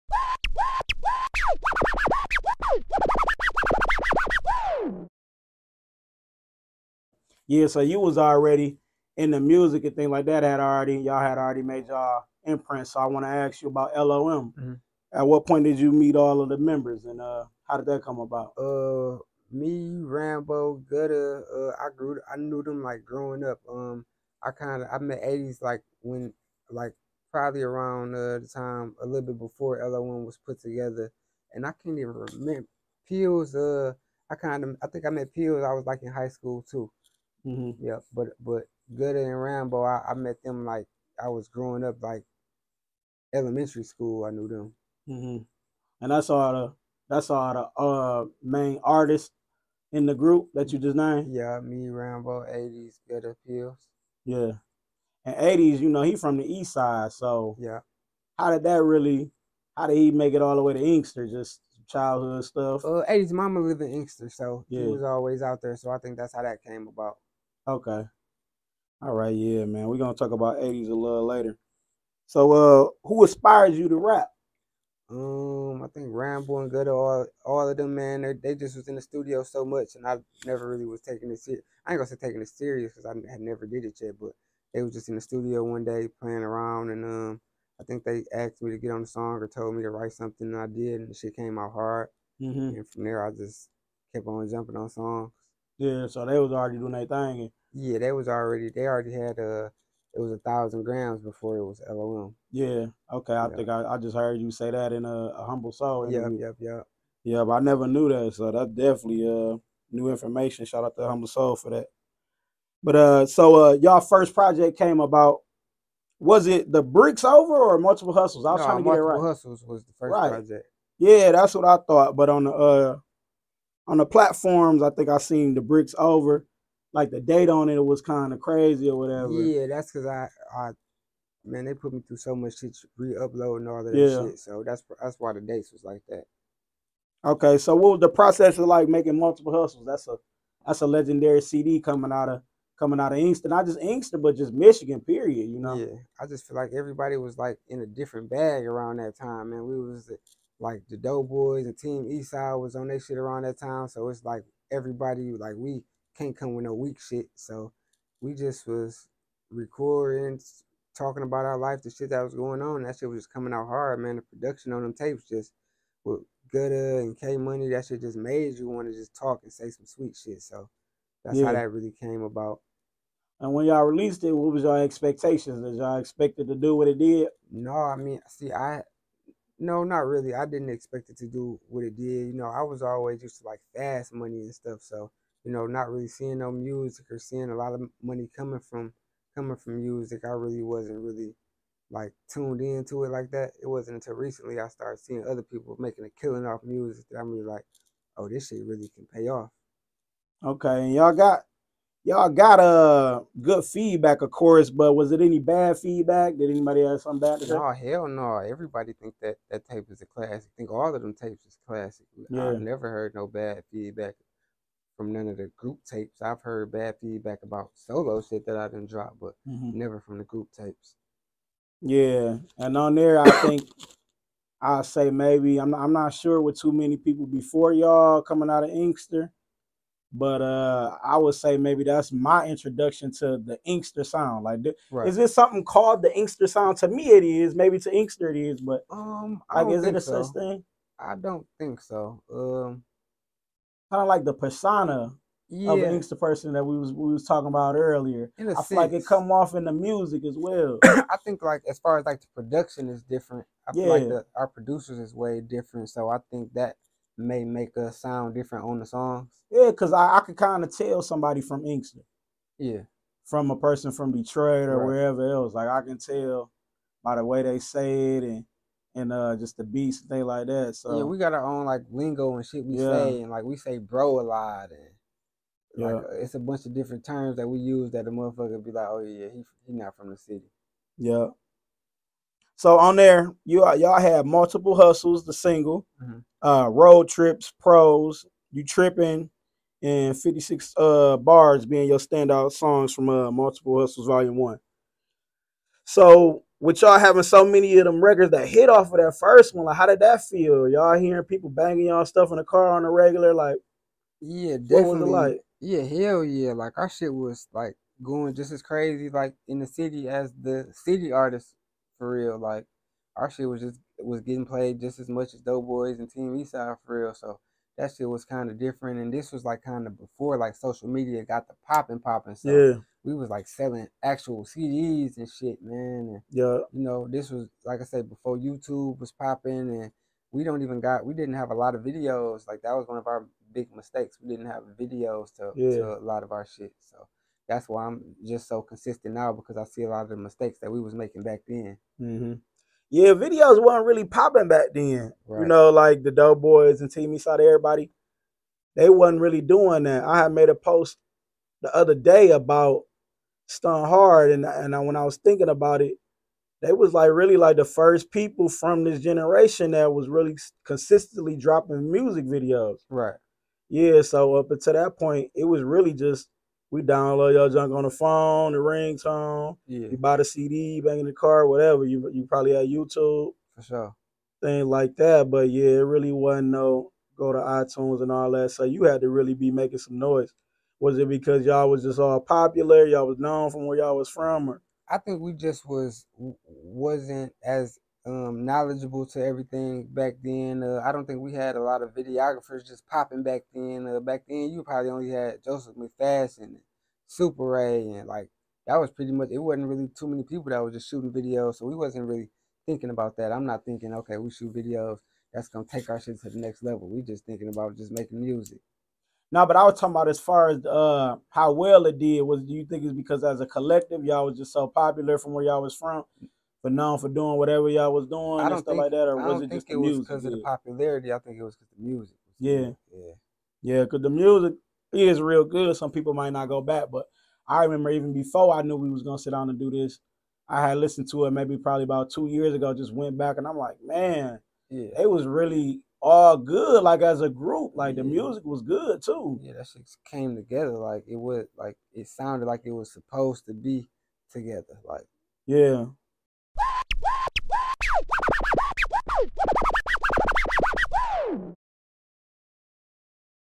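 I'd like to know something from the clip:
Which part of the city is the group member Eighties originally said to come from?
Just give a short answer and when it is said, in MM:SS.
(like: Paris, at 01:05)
The east side, at 00:56.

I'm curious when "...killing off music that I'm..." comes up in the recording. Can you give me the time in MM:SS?
03:16.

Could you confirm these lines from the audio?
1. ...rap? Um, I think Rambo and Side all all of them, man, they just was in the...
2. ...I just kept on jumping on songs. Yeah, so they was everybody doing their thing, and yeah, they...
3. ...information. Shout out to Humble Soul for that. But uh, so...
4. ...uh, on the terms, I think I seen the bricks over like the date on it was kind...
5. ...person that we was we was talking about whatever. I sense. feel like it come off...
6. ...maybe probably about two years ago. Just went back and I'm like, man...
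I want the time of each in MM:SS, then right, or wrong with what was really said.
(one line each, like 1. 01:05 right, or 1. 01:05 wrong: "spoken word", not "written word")
1. 01:13 wrong: "Good", not "Side"
2. 01:33 wrong: "already", not "everybody"
3. 01:50 right
4. 02:02 wrong: "platforms", not "terms"
5. 04:06 wrong: "earlier", not "whatever"
6. 07:11 right.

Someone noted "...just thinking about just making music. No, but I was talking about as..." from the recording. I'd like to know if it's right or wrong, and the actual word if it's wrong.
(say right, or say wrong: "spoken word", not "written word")
right.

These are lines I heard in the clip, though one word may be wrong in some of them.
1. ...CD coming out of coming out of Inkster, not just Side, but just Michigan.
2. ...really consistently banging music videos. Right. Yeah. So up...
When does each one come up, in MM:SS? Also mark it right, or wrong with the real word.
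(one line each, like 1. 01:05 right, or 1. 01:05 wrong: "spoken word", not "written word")
1. 02:21 wrong: "Inkster", not "Side"
2. 06:00 wrong: "dropping", not "banging".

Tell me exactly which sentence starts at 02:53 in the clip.
And when y'all released it, what was your expectations?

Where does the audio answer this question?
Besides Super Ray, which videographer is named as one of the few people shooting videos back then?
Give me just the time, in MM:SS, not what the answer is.
06:35.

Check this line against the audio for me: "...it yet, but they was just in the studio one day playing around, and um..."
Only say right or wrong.
right.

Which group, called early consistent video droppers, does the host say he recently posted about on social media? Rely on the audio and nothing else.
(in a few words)
Stun Hard.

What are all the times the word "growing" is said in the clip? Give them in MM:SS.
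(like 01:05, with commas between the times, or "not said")
00:23, 00:41.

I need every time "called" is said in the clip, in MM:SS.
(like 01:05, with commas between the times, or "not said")
03:55.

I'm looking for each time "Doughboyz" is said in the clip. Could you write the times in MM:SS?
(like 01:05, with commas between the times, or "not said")
02:30, 05:15, 05:46.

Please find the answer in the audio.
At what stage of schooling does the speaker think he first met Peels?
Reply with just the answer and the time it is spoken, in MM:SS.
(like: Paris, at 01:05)
High school, at 00:36.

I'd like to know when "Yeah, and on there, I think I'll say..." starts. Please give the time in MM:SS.
03:41.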